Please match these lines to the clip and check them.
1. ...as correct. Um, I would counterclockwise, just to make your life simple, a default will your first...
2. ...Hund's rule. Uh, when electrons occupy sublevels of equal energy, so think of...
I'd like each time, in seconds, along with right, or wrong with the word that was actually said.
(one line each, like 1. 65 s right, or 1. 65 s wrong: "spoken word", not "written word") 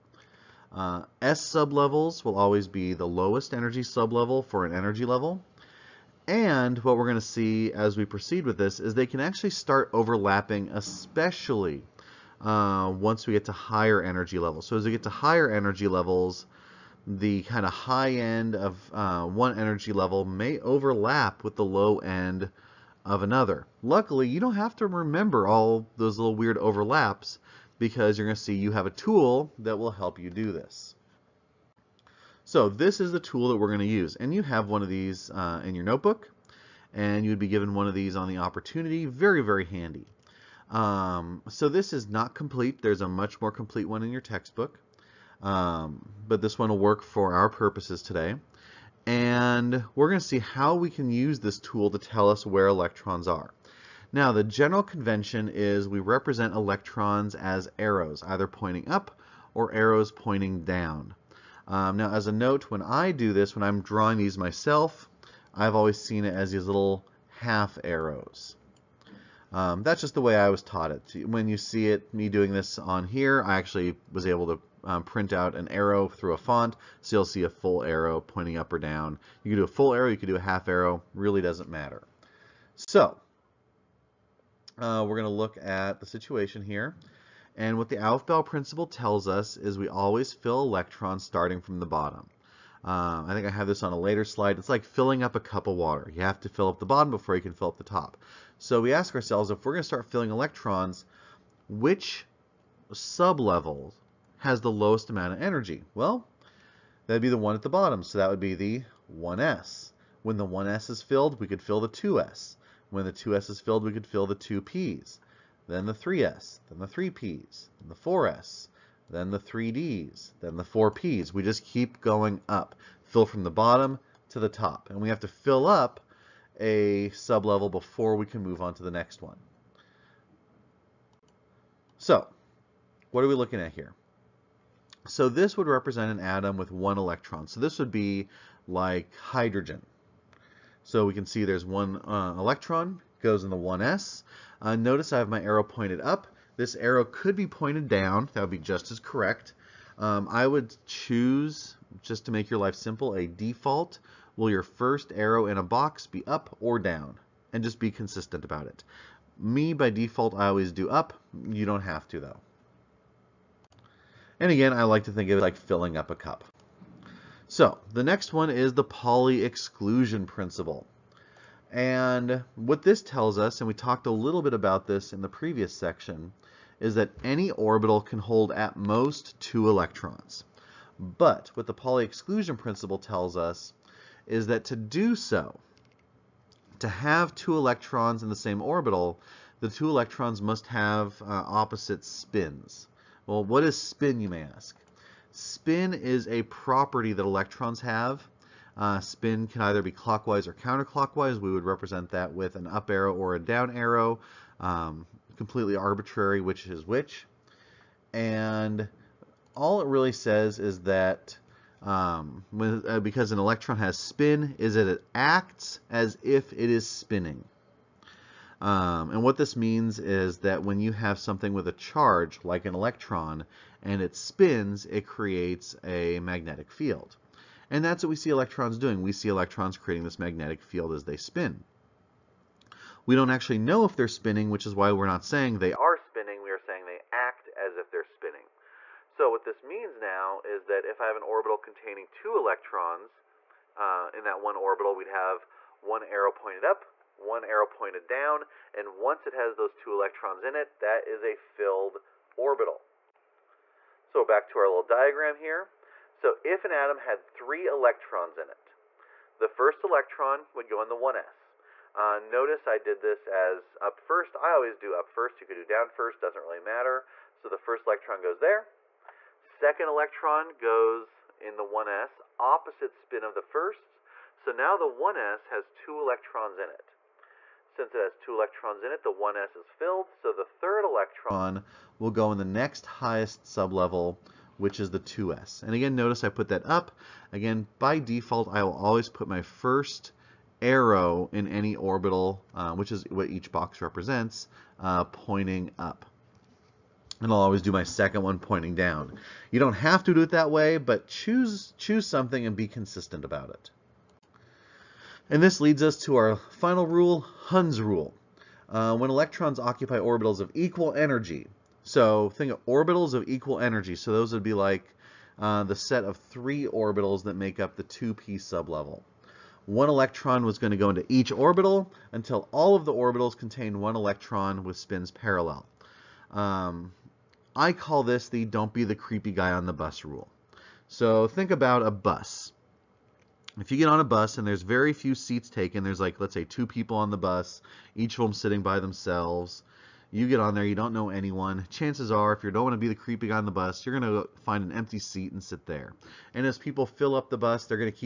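1. 148 s wrong: "choose", not "counterclockwise"
2. 307 s wrong: "orbitals", not "sublevels".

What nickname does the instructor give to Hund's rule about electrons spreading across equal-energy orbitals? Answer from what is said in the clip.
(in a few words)
the don't be the creepy guy on the bus rule.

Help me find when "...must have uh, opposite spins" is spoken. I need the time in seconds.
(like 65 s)
190 s.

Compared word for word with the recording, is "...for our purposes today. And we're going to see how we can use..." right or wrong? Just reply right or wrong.
right.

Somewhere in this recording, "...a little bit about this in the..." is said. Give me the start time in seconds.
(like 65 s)
174 s.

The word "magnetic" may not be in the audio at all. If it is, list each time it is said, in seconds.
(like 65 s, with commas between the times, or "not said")
226 s, 230 s.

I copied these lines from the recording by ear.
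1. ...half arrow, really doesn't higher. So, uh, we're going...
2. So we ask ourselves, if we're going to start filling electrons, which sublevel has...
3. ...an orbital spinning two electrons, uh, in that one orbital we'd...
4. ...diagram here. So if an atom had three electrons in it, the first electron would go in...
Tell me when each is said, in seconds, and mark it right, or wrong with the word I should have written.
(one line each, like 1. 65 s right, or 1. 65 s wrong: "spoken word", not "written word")
1. 80 s wrong: "matter", not "higher"
2. 98 s right
3. 241 s wrong: "containing", not "spinning"
4. 254 s right.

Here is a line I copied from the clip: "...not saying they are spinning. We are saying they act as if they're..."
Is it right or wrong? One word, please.
right.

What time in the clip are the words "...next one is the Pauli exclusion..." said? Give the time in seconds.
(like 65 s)
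168 s.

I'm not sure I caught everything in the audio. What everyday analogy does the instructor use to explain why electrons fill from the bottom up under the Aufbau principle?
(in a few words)
filling up a cup of water.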